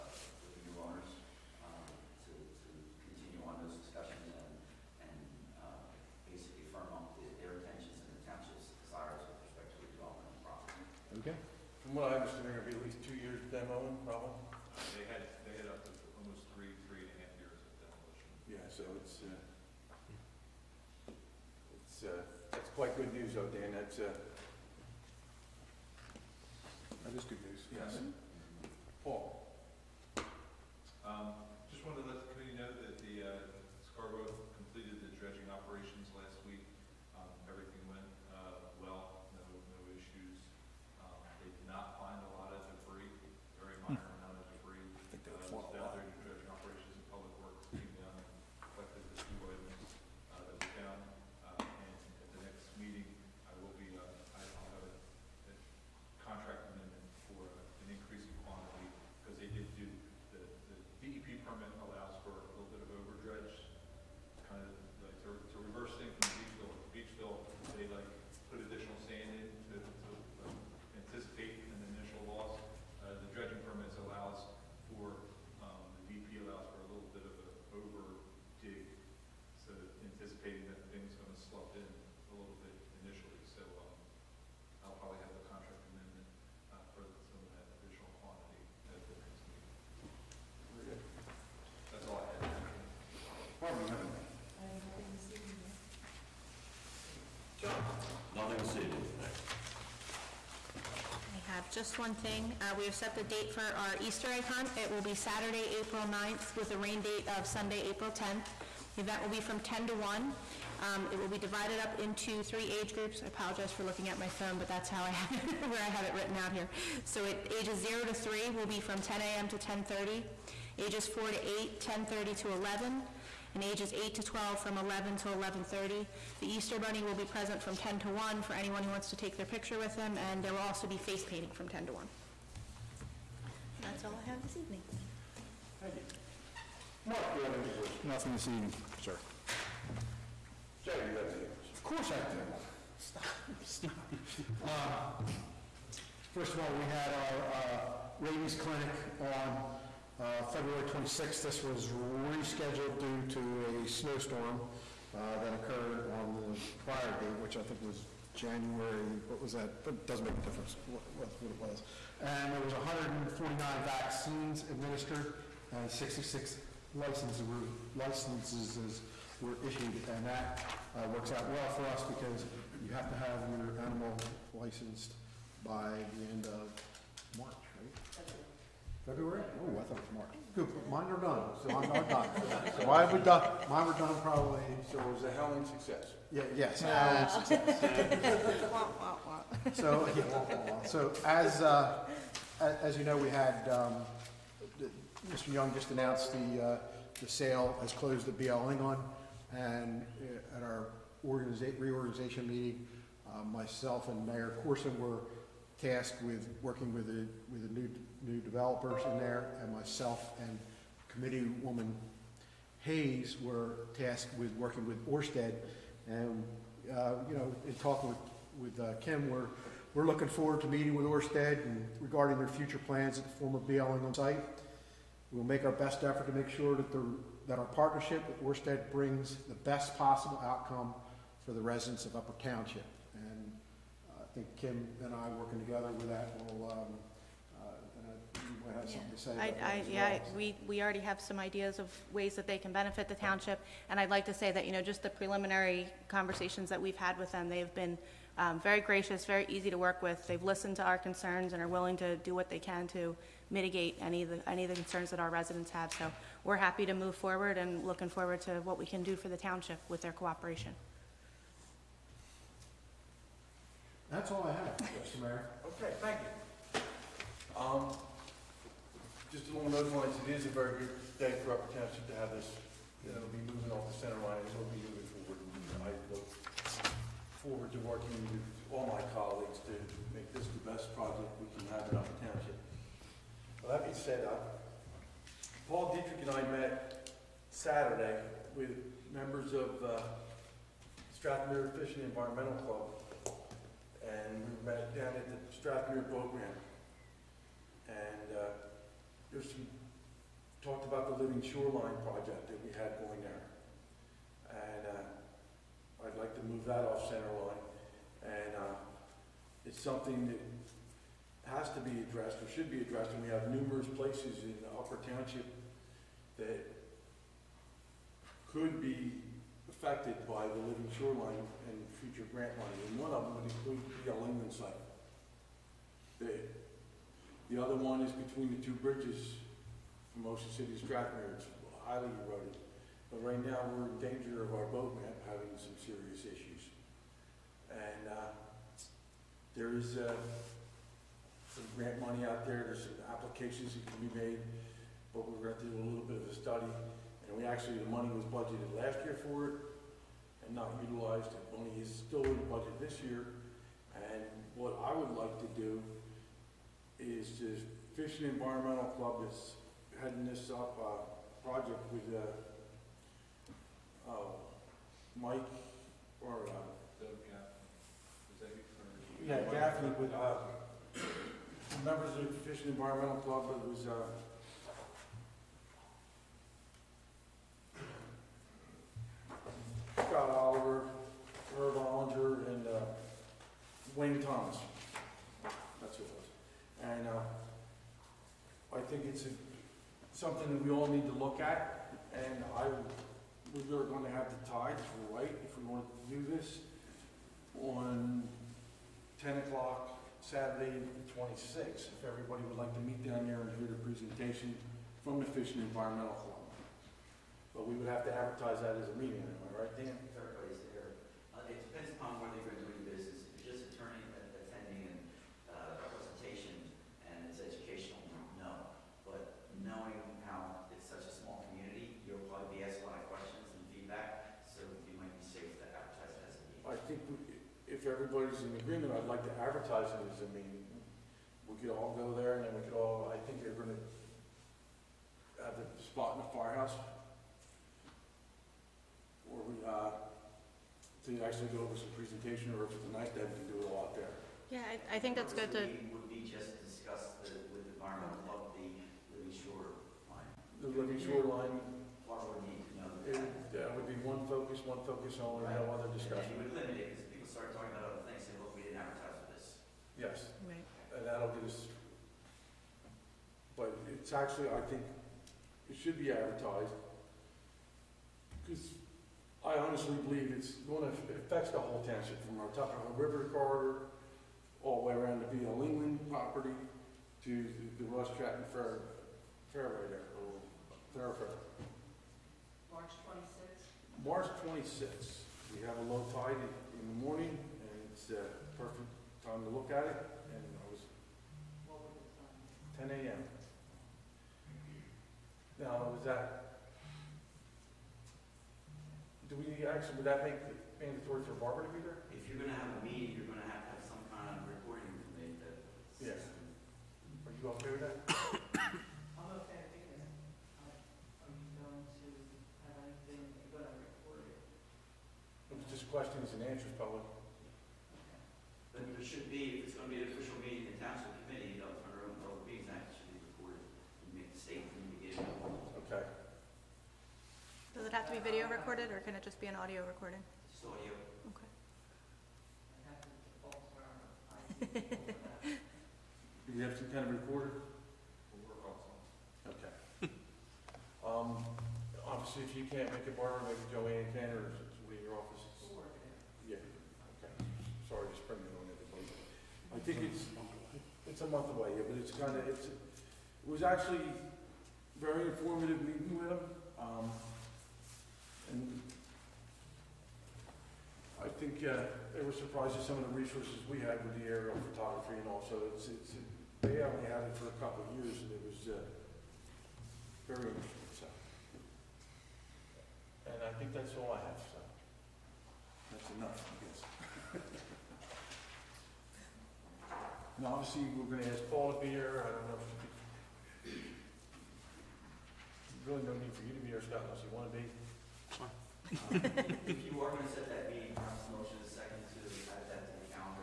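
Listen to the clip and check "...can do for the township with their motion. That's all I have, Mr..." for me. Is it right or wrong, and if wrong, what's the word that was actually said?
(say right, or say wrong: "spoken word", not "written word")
wrong: "cooperation", not "motion".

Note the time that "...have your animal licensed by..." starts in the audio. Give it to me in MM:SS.
02:53.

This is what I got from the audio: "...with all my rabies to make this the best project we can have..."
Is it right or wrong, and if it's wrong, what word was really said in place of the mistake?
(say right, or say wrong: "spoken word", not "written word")
wrong: "colleagues", not "rabies".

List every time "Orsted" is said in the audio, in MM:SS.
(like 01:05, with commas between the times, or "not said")
03:35, 03:41, 03:48.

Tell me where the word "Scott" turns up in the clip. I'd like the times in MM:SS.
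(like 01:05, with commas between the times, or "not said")
06:20, 09:46.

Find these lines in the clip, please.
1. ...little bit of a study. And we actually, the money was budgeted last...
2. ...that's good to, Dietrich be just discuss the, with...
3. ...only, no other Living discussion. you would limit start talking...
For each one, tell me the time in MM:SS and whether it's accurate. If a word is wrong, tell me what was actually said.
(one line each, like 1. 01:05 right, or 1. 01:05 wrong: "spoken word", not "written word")
1. 05:45 right
2. 07:25 wrong: "Would", not "Dietrich"
3. 07:35 wrong: "And", not "Living".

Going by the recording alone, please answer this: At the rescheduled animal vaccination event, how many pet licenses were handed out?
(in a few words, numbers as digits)
66.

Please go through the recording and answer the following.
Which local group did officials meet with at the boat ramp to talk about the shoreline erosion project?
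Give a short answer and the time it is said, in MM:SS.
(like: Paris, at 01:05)
Strathmere Fishing Environmental Club, at 04:51.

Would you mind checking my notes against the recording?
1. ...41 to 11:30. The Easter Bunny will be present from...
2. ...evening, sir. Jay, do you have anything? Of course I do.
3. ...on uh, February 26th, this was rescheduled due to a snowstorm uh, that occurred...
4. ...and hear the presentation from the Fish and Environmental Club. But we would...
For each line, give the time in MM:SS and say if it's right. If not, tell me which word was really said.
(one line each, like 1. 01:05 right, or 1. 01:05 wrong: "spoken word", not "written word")
1. 02:04 wrong: "11", not "41"
2. 02:18 right
3. 02:29 right
4. 06:43 right.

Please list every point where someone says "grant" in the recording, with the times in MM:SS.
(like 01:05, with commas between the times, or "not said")
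05:22, 05:41.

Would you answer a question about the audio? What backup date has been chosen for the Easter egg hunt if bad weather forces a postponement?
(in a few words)
Sunday, April 10th.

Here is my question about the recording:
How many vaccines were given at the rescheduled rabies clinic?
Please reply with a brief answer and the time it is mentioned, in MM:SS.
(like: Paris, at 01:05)
149, at 02:42.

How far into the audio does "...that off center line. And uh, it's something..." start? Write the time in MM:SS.
05:06.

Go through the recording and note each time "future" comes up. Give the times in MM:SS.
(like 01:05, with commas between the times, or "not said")
03:42, 05:21.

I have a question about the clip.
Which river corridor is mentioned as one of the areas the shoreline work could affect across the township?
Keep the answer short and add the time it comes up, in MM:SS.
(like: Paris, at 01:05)
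Tuckahoe River, at 07:52.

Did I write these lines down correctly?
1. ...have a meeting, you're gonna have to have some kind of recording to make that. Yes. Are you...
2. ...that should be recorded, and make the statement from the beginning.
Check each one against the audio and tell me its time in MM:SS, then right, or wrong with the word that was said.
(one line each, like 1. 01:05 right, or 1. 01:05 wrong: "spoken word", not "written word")
1. 08:22 right
2. 08:42 right.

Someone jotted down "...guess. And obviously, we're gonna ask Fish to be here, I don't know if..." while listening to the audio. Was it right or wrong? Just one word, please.
wrong.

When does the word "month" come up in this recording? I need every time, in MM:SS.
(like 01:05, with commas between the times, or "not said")
09:11.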